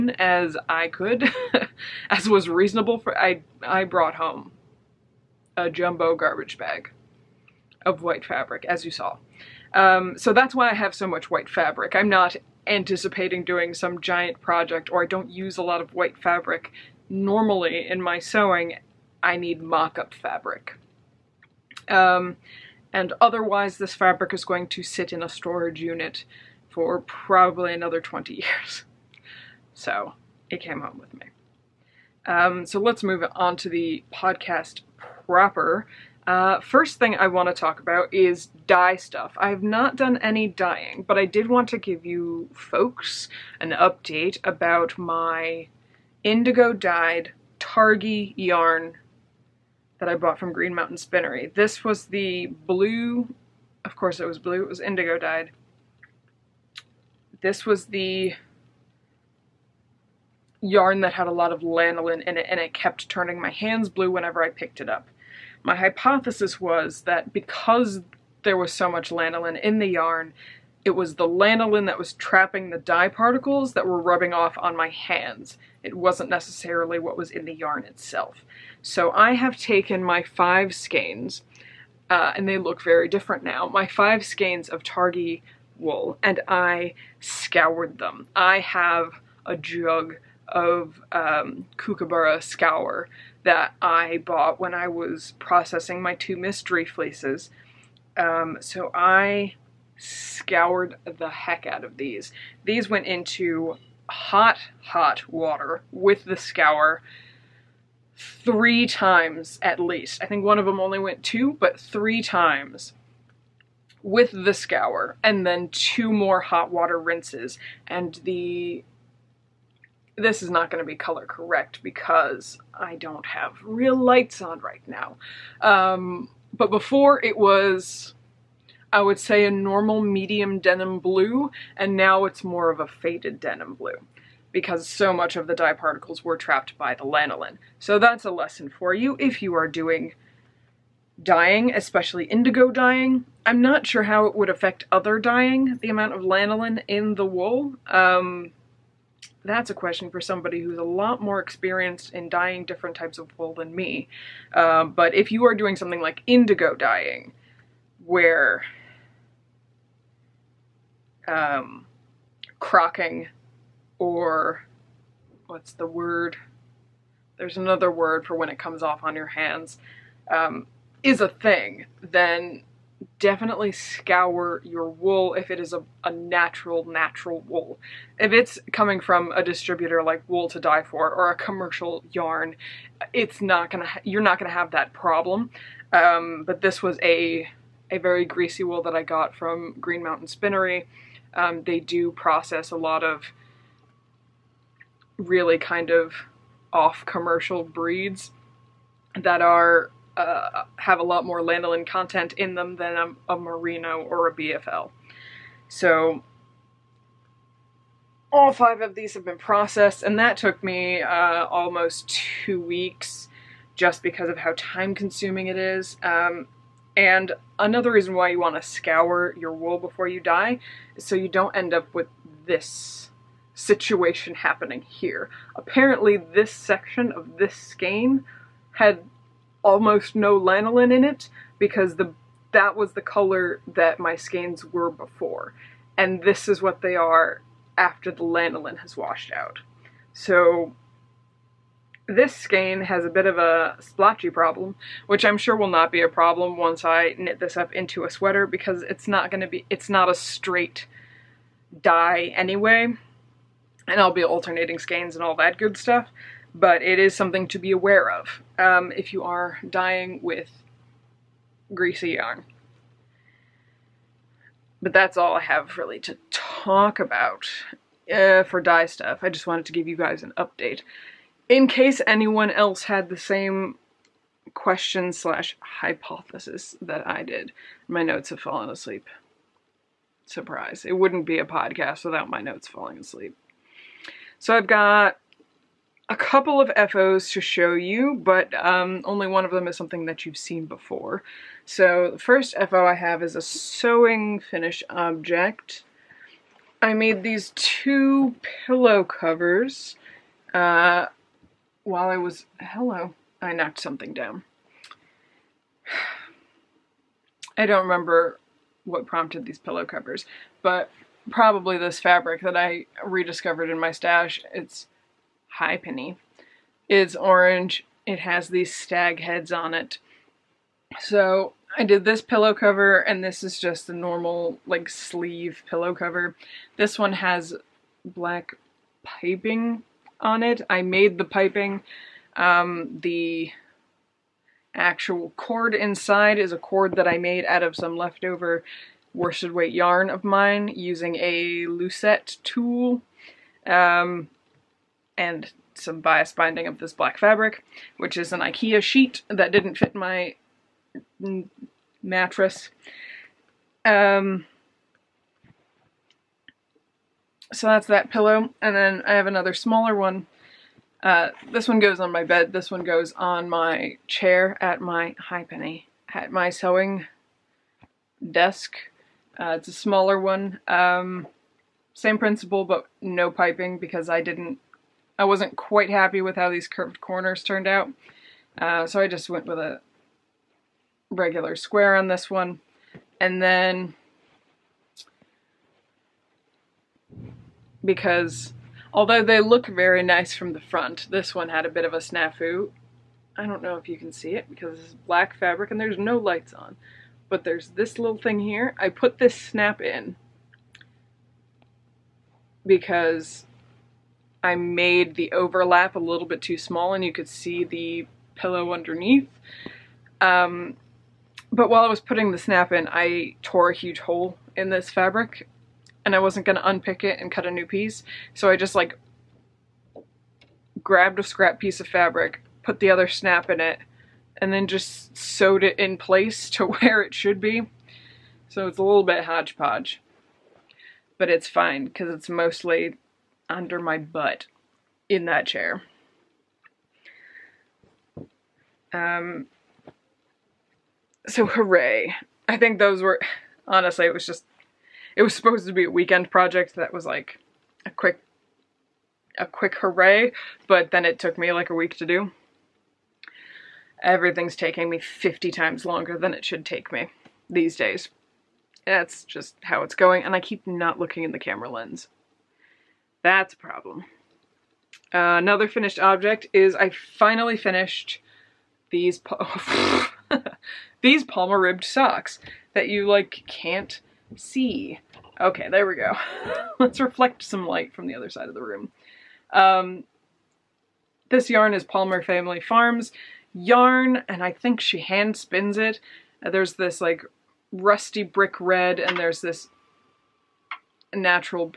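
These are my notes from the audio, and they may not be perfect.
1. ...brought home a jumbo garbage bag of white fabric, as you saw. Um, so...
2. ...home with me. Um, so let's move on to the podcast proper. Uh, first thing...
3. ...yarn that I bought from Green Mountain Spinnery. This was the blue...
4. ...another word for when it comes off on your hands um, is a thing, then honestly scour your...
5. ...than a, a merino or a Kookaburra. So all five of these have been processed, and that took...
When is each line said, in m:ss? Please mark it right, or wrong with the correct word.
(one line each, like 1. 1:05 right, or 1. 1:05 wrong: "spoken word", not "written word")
1. 0:03 right
2. 0:30 right
3. 0:48 right
4. 2:47 wrong: "definitely", not "honestly"
5. 3:22 wrong: "BFL", not "Kookaburra".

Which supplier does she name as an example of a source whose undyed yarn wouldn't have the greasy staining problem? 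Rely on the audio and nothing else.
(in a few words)
Wool2Dye4.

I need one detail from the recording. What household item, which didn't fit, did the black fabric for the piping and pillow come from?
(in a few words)
Ikea sheet.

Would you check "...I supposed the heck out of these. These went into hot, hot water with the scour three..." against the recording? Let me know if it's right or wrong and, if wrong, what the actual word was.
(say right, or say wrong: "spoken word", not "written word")
wrong: "scoured", not "supposed".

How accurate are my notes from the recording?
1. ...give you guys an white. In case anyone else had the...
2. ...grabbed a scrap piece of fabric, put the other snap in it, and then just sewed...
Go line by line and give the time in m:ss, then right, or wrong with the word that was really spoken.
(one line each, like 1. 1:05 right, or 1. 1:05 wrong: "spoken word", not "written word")
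1. 4:29 wrong: "update", not "white"
2. 7:00 right.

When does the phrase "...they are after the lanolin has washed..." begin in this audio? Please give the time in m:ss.
3:56.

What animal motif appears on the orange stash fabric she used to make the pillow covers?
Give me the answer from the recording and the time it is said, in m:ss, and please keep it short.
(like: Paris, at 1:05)
stag heads, at 5:18.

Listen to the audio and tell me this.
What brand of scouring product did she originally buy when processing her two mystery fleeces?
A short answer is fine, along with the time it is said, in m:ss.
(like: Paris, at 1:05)
Kookaburra Scour, at 1:31.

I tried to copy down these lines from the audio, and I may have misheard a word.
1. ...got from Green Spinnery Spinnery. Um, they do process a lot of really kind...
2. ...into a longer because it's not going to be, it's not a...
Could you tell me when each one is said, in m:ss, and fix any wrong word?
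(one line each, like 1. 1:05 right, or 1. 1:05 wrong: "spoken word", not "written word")
1. 3:09 wrong: "Mountain", not "Spinnery"
2. 4:07 wrong: "sweater", not "longer".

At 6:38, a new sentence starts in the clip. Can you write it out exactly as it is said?
I put this snap in because I made the overlap a little bit too small and you could see the pillow underneath.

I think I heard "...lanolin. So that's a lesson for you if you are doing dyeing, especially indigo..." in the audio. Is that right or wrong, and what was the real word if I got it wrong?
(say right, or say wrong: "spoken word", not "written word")
right.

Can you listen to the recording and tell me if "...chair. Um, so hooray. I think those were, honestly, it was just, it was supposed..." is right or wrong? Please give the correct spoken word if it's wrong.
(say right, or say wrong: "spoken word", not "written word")
right.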